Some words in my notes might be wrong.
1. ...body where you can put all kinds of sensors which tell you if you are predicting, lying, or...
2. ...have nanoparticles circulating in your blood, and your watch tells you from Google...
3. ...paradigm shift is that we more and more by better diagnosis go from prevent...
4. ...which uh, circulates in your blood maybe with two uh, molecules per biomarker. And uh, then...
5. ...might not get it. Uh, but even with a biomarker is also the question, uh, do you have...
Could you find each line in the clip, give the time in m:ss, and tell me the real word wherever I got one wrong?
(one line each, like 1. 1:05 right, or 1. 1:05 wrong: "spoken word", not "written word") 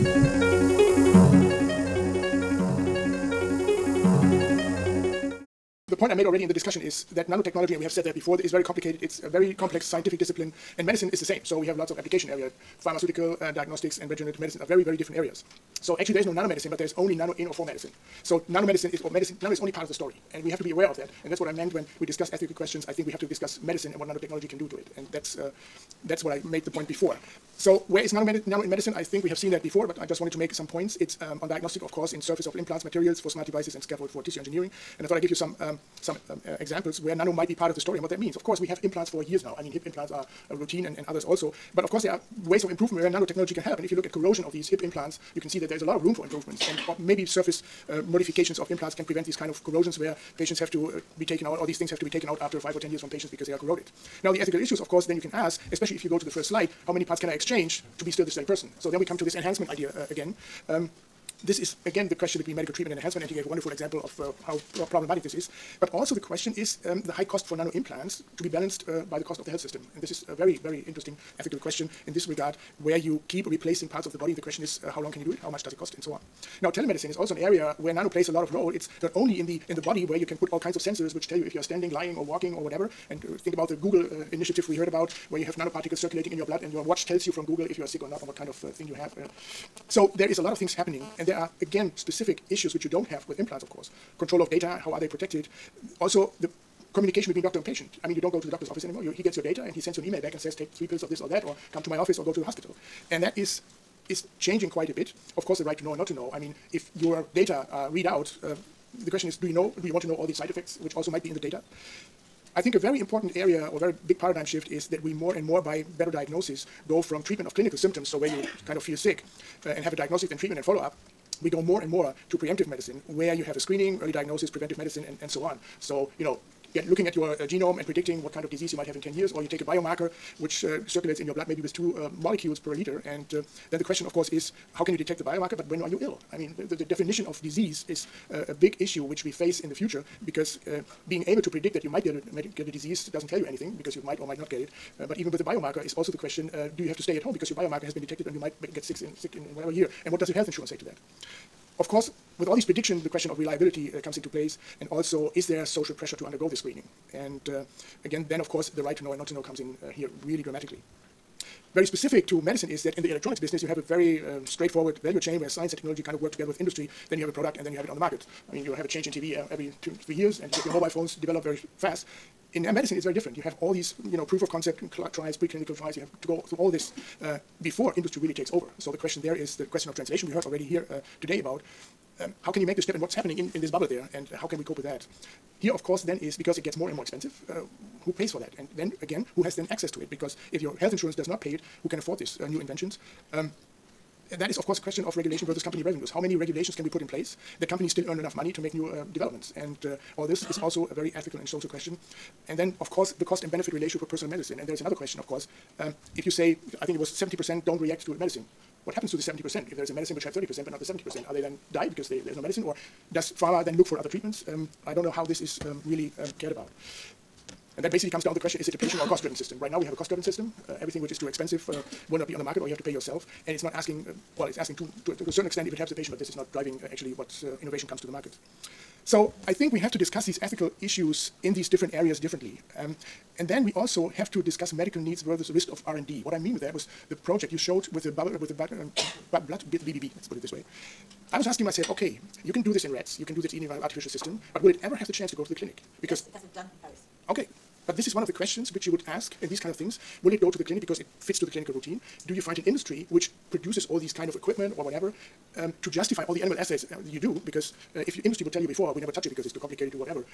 1. 1:19 wrong: "standing", not "predicting"
2. 1:25 right
3. 1:54 wrong: "treatment", not "prevent"
4. 2:10 wrong: "liter", not "biomarker"
5. 2:24 right.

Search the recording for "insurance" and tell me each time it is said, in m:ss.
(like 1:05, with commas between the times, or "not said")
2:30, 3:10.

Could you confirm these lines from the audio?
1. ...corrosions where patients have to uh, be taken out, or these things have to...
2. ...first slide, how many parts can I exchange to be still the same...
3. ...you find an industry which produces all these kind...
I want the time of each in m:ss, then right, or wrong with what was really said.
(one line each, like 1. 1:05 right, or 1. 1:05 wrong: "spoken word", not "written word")
1. 0:49 right
2. 0:56 right
3. 4:12 right.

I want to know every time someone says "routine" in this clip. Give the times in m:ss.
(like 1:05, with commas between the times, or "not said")
0:40, 4:11.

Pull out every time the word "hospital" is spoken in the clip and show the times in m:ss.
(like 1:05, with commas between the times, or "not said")
1:42.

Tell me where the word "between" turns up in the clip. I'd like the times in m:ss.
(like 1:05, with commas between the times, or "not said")
1:02, 1:37.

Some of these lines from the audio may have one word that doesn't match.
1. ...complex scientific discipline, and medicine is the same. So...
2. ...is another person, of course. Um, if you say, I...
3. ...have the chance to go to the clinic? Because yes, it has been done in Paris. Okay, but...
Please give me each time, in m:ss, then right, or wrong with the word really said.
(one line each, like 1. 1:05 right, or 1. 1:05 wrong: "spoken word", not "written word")
1. 0:09 right
2. 3:24 wrong: "question", not "person"
3. 4:04 right.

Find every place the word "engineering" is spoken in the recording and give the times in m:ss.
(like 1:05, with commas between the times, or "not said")
0:34.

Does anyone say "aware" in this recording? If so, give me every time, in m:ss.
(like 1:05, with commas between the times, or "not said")
0:20.